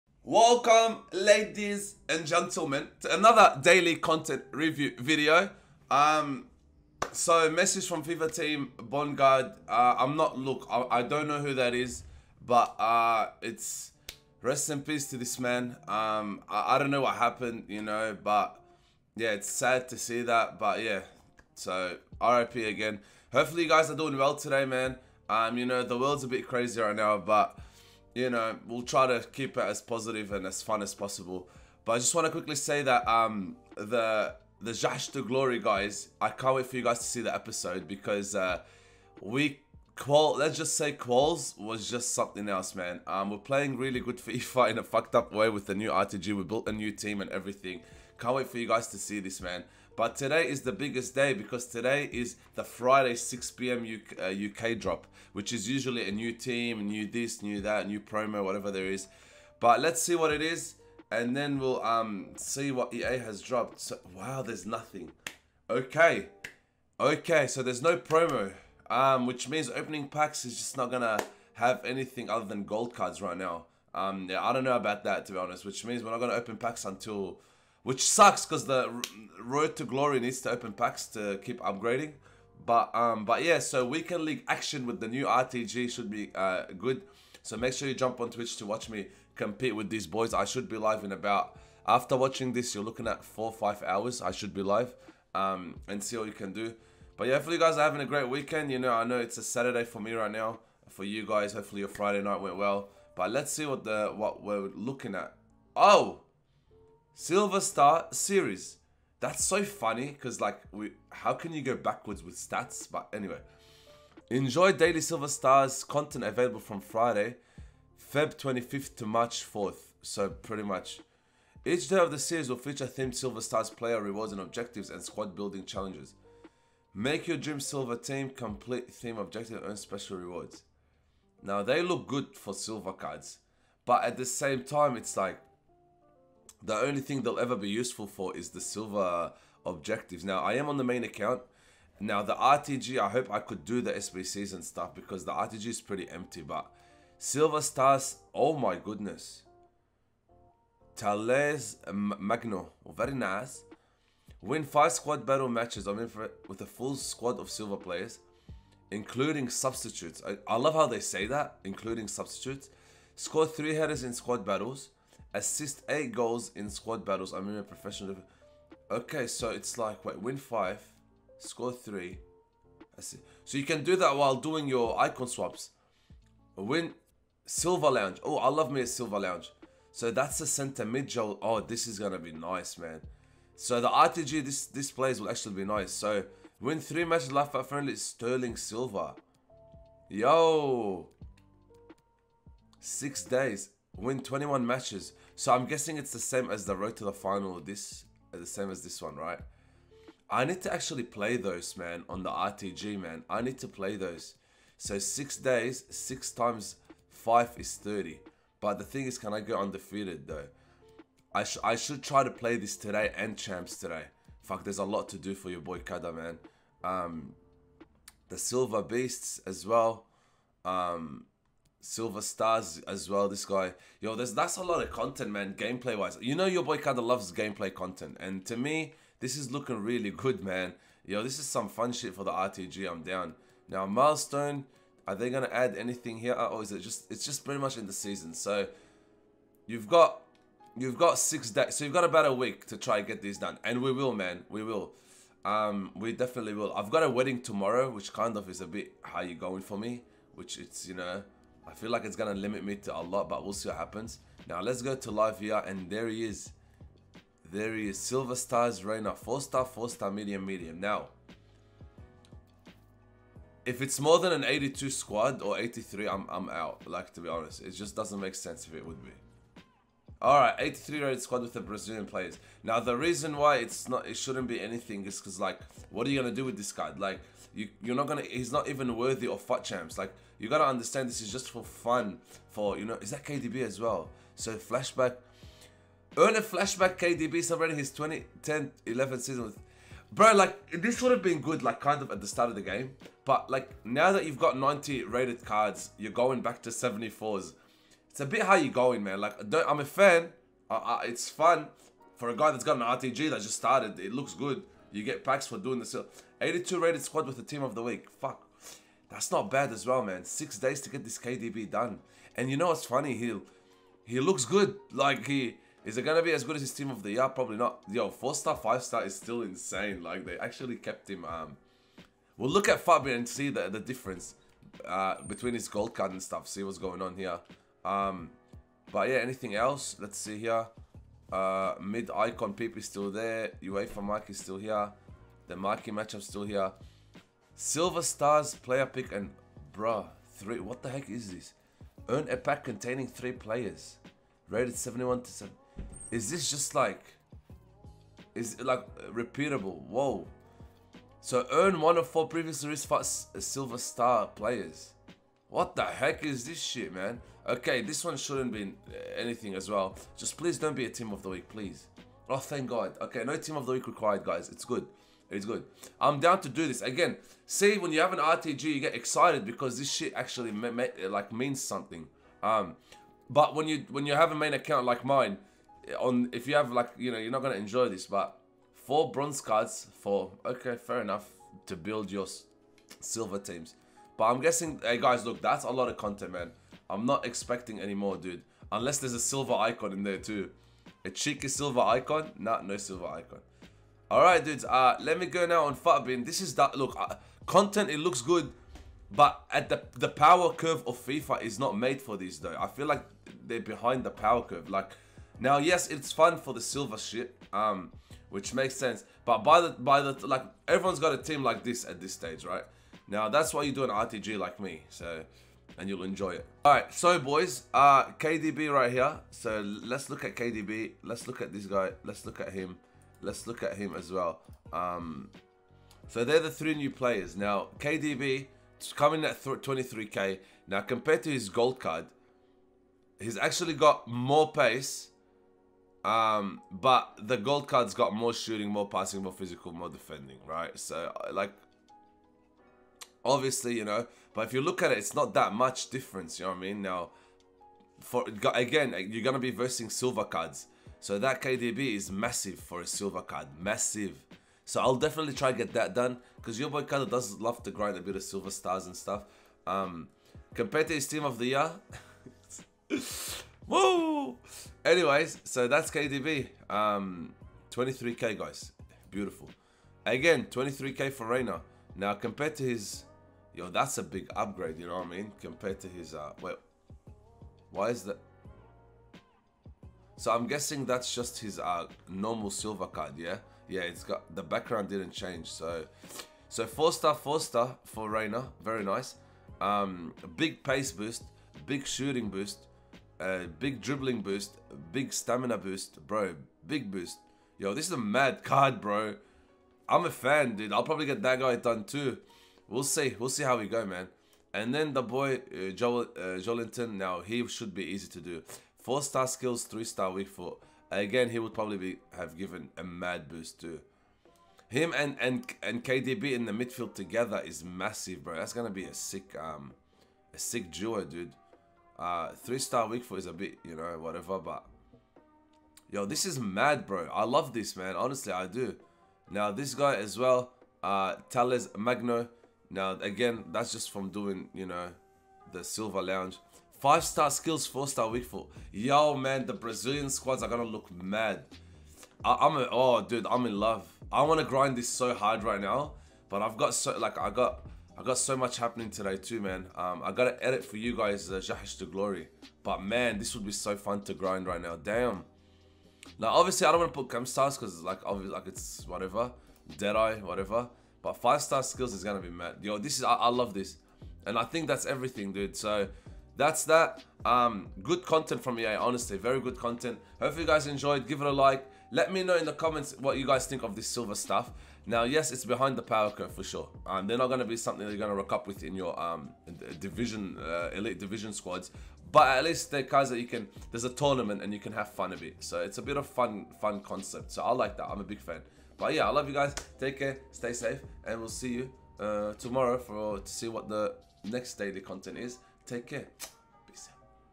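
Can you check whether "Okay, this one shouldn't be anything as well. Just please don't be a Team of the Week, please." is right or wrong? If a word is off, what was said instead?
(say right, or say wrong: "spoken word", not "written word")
right.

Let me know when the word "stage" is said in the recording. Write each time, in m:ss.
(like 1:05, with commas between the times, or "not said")
6:52.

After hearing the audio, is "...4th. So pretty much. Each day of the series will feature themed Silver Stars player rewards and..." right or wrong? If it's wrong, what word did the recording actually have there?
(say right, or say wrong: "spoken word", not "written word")
right.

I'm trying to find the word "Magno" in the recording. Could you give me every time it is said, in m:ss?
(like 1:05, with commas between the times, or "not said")
2:31, 8:51.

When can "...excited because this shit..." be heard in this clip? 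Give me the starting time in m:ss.
6:08.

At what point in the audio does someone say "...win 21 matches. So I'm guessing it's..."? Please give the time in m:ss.
3:13.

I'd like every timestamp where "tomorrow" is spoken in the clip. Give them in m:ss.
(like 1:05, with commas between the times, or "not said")
4:07, 9:52.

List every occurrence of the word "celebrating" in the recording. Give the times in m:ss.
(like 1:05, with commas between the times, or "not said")
4:47.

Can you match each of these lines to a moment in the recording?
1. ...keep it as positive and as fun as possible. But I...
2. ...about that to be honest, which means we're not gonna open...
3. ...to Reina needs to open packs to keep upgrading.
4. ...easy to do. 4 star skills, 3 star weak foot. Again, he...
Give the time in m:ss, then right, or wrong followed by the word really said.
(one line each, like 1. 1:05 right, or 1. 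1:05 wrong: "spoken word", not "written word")
1. 0:29 right
2. 1:14 right
3. 1:19 wrong: "Glory", not "Reina"
4. 8:27 right.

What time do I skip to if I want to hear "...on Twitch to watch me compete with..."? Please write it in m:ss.
1:28.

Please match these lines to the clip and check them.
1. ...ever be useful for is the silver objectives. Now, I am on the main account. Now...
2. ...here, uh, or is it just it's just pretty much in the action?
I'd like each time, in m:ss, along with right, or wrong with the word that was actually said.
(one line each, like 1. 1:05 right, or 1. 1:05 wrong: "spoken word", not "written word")
1. 2:17 right
2. 3:56 wrong: "season", not "action".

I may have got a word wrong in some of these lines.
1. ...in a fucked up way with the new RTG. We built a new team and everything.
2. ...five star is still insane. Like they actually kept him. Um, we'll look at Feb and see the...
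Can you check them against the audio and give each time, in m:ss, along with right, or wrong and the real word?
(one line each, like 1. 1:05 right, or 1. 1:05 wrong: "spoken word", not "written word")
1. 0:44 right
2. 5:18 wrong: "Futbin", not "Feb".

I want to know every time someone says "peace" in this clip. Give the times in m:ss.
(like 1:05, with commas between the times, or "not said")
0:14.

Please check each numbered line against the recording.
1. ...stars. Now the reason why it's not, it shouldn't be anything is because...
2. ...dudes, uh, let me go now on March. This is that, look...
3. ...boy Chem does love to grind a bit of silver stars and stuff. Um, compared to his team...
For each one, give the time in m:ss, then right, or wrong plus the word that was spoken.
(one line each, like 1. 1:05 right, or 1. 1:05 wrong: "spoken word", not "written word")
1. 4:32 wrong: "players", not "stars"
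2. 6:34 wrong: "Futbin", not "March"
3. 7:36 wrong: "Kada", not "Chem".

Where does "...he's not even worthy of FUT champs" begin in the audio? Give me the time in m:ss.
4:38.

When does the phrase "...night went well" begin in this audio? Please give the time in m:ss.
1:42.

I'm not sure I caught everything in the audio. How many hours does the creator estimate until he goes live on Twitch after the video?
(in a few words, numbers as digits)
4 or 5 hours.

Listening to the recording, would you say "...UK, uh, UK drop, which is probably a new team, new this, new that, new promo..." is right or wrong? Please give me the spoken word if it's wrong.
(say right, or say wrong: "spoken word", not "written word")
wrong: "usually", not "probably".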